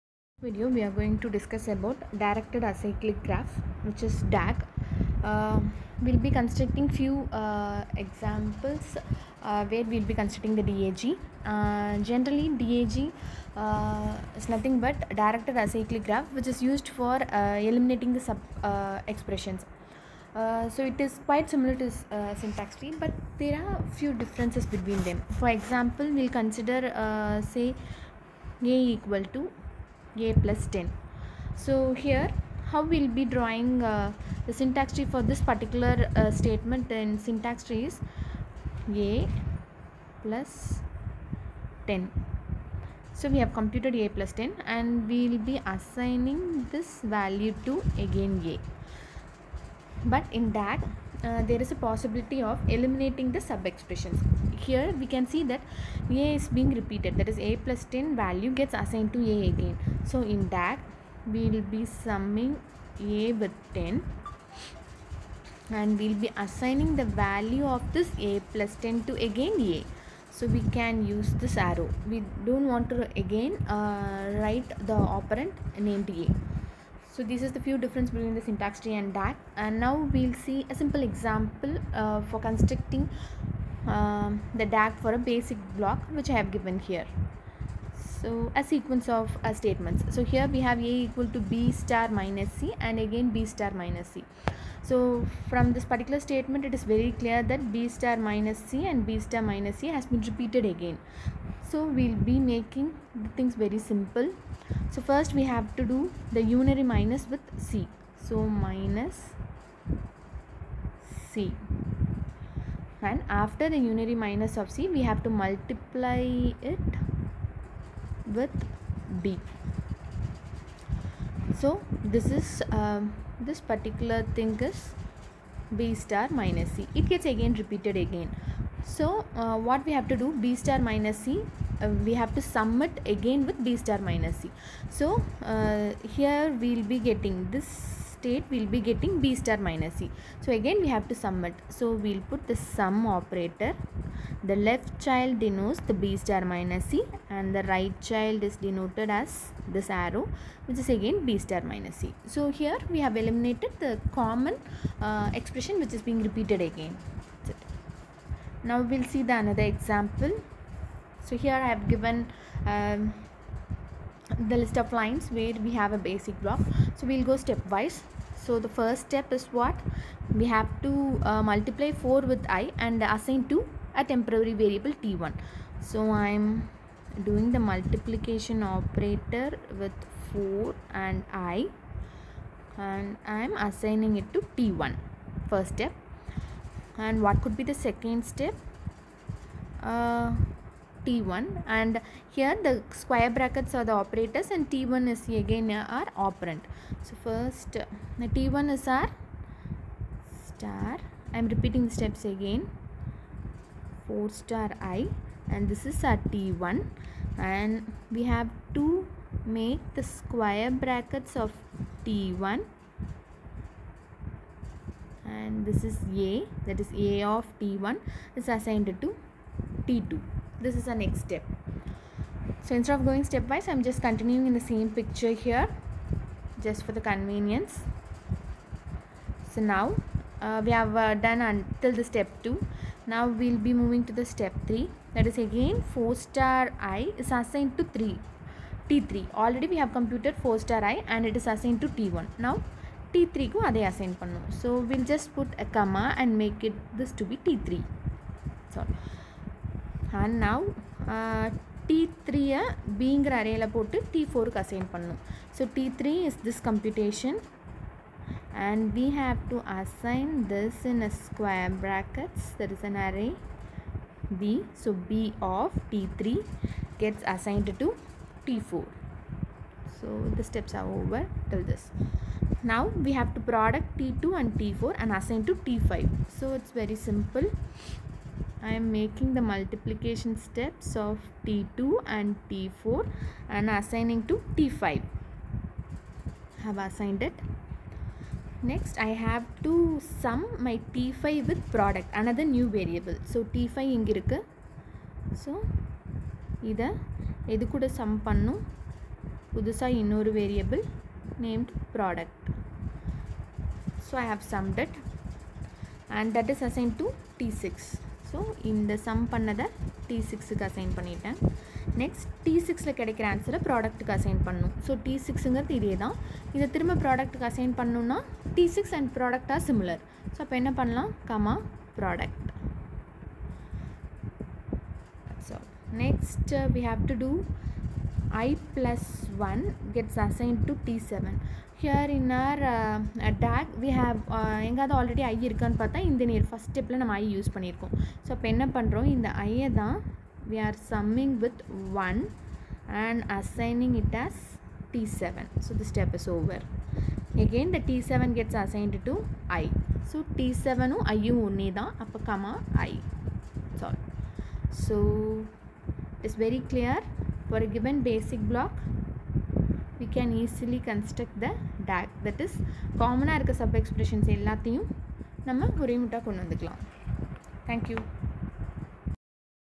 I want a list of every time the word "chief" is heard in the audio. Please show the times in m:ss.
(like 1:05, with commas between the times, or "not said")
not said.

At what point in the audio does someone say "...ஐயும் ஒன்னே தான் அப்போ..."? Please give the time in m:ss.
5:51.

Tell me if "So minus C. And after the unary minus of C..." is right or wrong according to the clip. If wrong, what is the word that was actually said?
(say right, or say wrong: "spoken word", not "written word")
right.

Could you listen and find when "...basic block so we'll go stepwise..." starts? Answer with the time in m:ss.
2:45.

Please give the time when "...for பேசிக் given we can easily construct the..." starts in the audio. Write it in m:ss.
5:57.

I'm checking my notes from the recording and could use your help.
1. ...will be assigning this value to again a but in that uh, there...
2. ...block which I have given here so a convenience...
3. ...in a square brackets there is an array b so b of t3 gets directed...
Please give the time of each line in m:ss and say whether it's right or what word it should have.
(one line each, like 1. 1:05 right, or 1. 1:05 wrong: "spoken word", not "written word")
1. 0:45 right
2. 1:25 wrong: "sequence", not "convenience"
3. 4:20 wrong: "assigned", not "directed".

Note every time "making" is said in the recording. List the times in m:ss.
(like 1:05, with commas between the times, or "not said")
1:42, 4:38.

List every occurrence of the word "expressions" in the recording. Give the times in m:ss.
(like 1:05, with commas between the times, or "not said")
0:19, 0:53, 2:35.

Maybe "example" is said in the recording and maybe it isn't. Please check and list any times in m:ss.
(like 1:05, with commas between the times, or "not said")
0:07, 0:25, 1:21, 2:39.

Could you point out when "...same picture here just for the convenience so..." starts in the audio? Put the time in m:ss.
3:44.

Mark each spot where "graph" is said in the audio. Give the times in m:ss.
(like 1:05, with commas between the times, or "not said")
0:03, 0:16.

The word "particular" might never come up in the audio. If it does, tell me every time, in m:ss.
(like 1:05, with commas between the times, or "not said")
0:35, 1:35, 2:03.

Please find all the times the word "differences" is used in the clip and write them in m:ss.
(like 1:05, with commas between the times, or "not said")
0:24, 1:17.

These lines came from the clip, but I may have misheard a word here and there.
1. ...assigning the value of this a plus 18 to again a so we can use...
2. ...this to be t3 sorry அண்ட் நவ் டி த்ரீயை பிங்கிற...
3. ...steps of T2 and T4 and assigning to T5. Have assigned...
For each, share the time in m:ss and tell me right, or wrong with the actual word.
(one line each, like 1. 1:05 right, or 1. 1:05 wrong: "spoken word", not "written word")
1. 1:06 wrong: "10", not "18"
2. 4:06 right
3. 4:40 right.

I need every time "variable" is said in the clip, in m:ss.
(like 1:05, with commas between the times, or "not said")
2:54, 4:52.